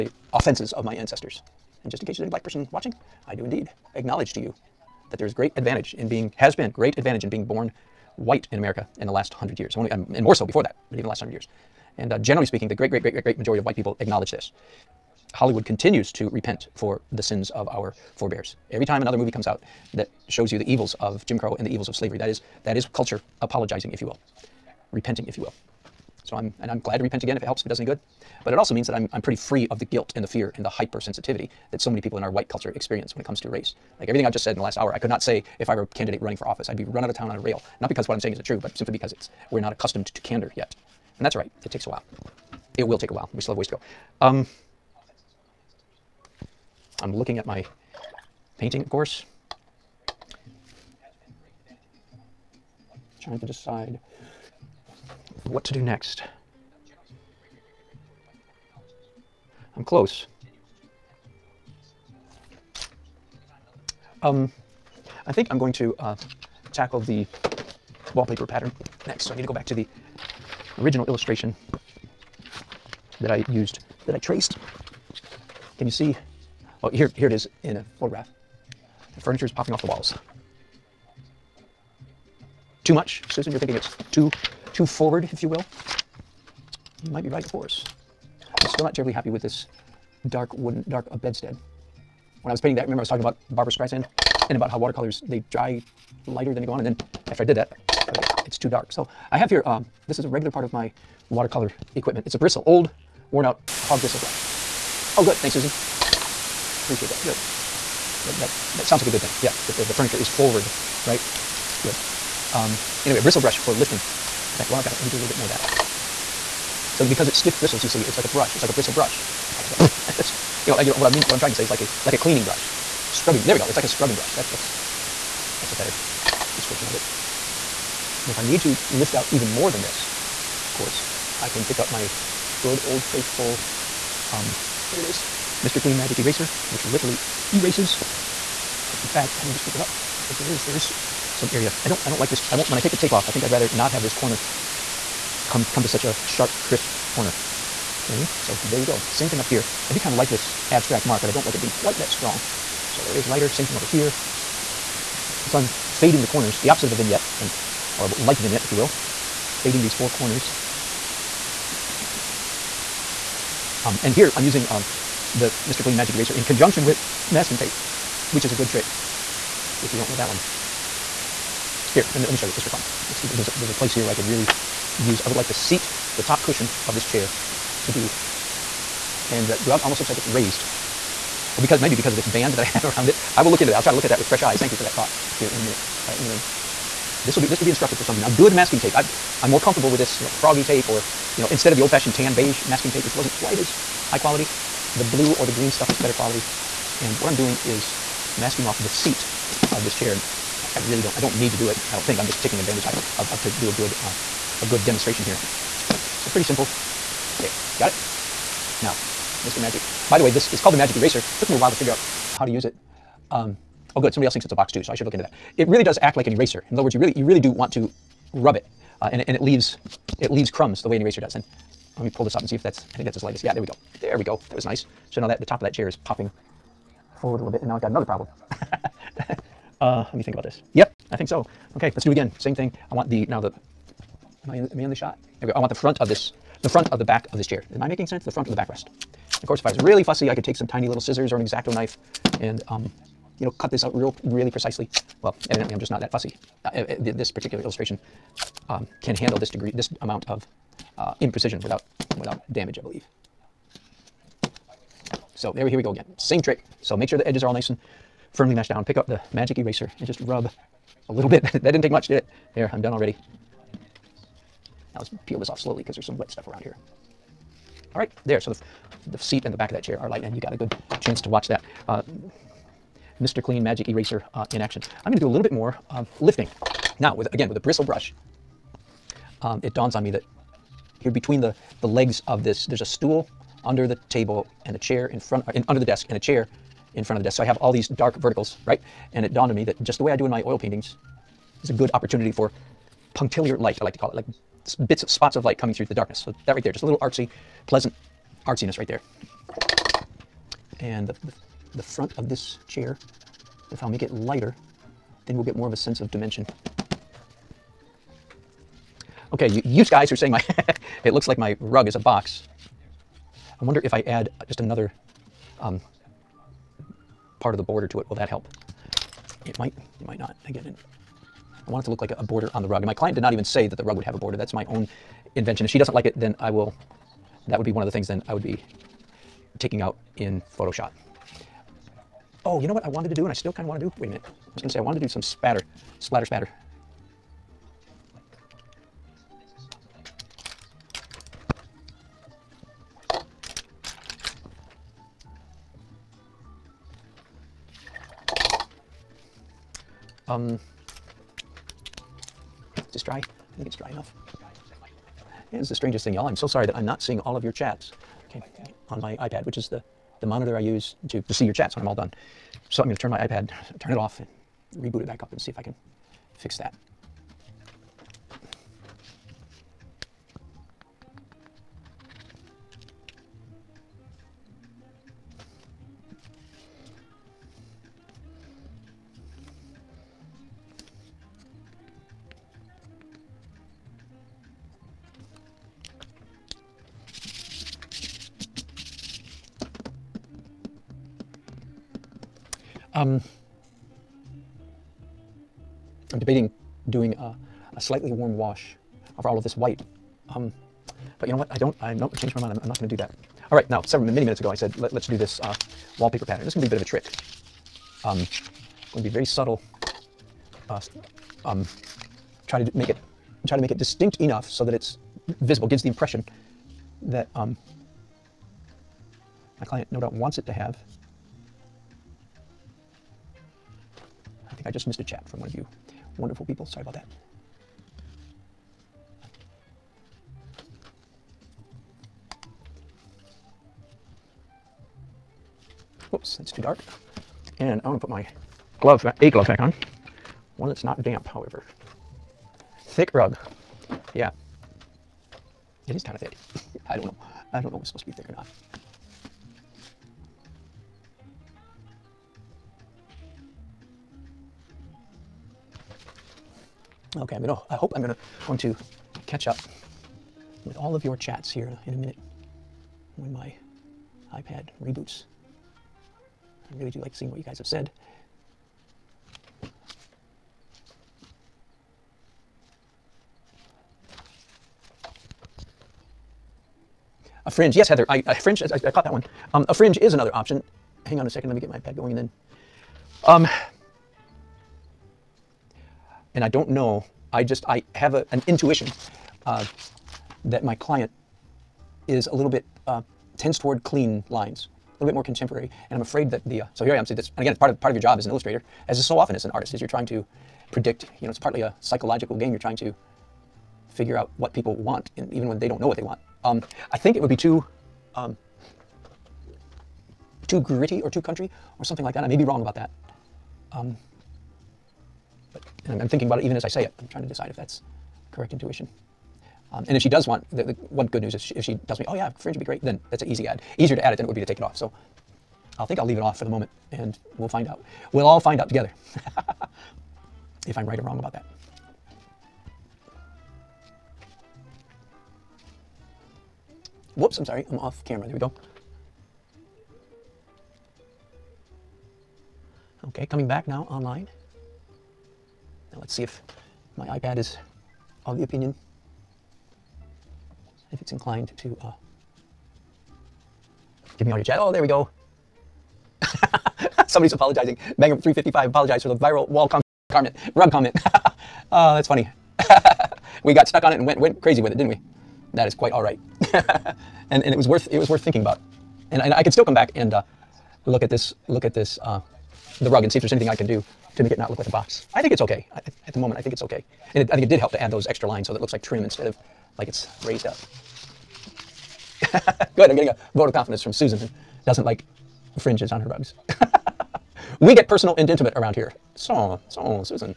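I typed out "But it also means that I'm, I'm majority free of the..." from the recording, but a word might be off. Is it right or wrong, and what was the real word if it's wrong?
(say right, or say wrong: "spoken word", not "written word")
wrong: "pretty", not "majority".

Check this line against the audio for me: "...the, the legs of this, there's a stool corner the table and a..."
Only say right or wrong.
wrong.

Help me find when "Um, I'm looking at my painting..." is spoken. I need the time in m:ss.
0:44.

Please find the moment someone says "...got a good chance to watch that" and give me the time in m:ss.
4:30.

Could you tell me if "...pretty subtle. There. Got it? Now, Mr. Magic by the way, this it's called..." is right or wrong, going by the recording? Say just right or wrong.
wrong.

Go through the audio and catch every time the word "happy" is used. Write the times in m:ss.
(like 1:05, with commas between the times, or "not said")
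1:29.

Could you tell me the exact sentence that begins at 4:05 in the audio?
Well, evidently I'm just not that fussy.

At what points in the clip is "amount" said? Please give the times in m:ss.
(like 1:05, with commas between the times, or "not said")
4:10.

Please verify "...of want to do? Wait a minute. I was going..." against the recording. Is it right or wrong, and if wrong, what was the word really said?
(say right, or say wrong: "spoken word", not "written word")
right.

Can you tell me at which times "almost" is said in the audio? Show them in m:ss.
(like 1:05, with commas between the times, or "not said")
2:59.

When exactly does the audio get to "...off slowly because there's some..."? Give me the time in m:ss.
4:25.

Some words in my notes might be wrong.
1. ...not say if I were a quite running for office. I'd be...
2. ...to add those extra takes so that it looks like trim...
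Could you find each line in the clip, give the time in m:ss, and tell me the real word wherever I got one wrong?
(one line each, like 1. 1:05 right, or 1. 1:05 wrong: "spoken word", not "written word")
1. 0:35 wrong: "candidate", not "quite"
2. 9:37 wrong: "lines", not "takes".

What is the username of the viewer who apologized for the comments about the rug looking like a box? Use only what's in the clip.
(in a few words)
Banger 355.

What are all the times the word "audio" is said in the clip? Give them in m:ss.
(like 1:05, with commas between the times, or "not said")
9:14.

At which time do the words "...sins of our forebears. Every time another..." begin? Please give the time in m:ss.
0:17.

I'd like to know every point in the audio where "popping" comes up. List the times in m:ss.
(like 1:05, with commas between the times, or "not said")
1:19, 3:46.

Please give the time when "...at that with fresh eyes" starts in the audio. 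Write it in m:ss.
3:04.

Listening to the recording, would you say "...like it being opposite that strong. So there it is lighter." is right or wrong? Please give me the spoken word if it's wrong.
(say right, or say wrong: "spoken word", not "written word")
wrong: "quite", not "opposite".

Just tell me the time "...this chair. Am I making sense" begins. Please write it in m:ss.
3:57.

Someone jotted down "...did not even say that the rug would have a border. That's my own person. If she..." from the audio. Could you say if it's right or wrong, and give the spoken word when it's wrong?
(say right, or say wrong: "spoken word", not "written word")
wrong: "invention", not "person".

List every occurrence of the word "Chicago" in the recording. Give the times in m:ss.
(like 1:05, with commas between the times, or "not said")
not said.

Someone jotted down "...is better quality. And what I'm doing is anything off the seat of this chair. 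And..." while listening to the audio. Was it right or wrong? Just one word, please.
wrong.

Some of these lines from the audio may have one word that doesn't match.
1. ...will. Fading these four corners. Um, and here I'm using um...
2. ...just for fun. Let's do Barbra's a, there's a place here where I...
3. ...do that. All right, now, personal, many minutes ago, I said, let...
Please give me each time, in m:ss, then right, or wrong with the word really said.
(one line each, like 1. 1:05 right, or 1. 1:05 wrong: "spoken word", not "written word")
1. 2:38 right
2. 2:52 wrong: "There", not "Barbra"
3. 6:42 wrong: "several", not "personal".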